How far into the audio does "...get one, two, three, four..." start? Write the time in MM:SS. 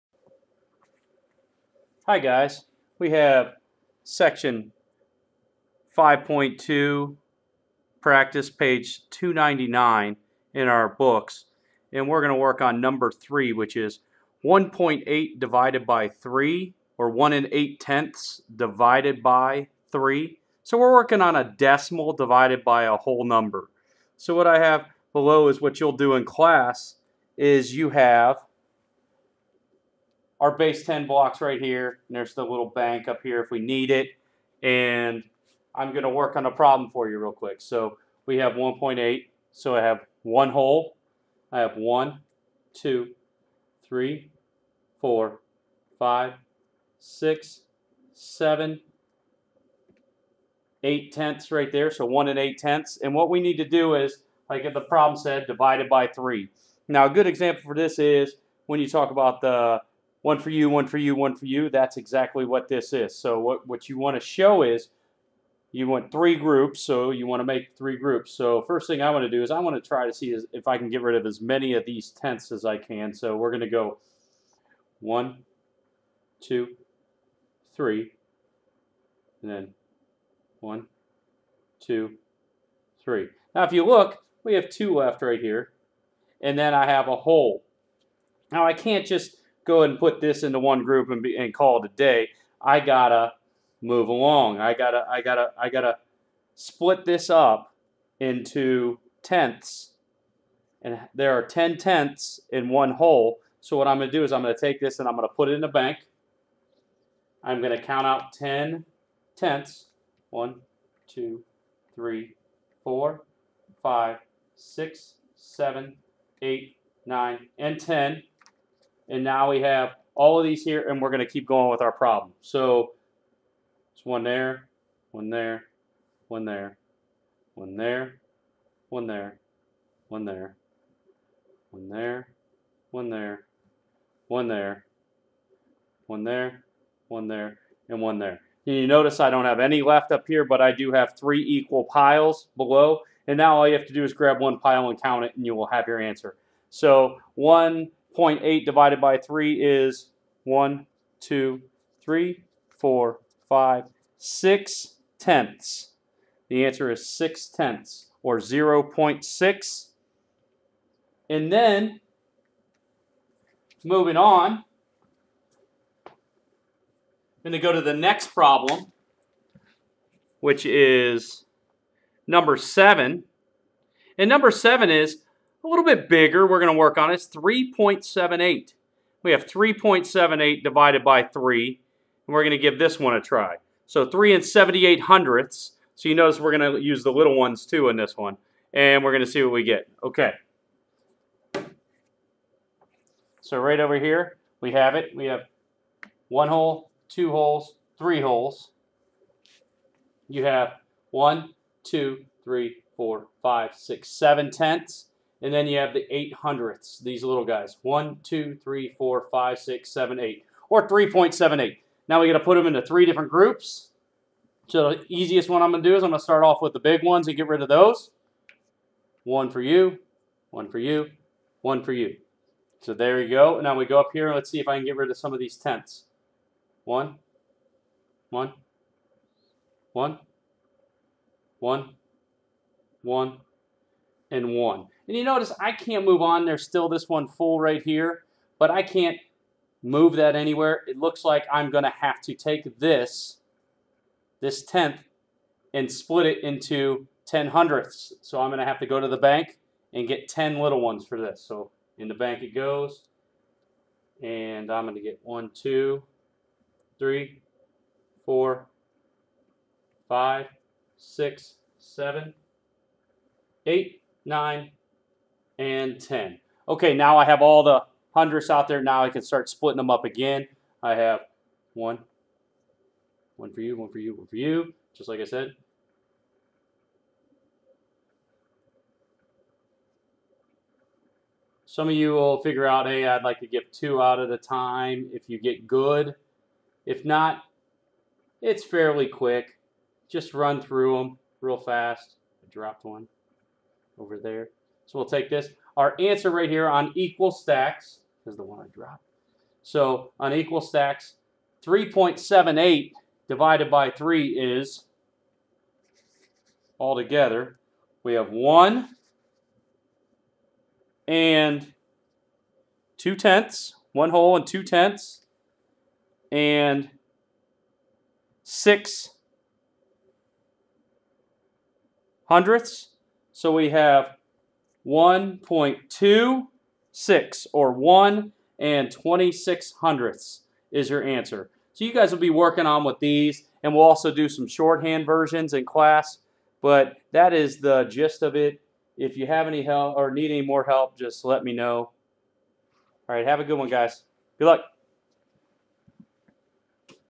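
04:15.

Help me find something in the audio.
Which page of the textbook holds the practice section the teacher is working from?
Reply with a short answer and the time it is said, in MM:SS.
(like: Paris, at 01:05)
299, at 00:08.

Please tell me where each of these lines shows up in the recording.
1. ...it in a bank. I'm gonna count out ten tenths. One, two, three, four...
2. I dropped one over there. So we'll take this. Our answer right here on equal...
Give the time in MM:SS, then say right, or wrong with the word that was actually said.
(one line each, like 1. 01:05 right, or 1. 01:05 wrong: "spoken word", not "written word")
1. 01:45 right
2. 04:52 right.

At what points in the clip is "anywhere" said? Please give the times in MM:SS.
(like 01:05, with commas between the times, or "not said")
04:00.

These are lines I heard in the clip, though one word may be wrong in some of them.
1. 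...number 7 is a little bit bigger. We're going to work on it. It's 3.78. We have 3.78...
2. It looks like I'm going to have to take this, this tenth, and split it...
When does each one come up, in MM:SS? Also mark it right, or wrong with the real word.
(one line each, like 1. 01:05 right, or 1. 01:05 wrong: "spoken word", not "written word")
1. 02:54 right
2. 04:00 right.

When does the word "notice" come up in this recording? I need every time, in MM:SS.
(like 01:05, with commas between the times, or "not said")
02:18, 03:06, 03:55.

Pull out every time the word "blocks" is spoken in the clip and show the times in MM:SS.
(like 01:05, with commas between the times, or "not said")
00:31.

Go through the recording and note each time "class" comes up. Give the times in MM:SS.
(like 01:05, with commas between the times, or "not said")
00:26, 05:35.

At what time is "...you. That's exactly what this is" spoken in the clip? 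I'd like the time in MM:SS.
01:01.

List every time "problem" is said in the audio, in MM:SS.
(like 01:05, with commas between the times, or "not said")
00:36, 00:54, 02:01, 02:48.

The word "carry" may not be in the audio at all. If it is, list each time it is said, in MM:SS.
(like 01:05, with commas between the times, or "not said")
not said.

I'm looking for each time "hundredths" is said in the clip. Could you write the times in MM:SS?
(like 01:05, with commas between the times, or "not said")
03:05, 03:26, 04:07, 04:28, 05:22, 05:29.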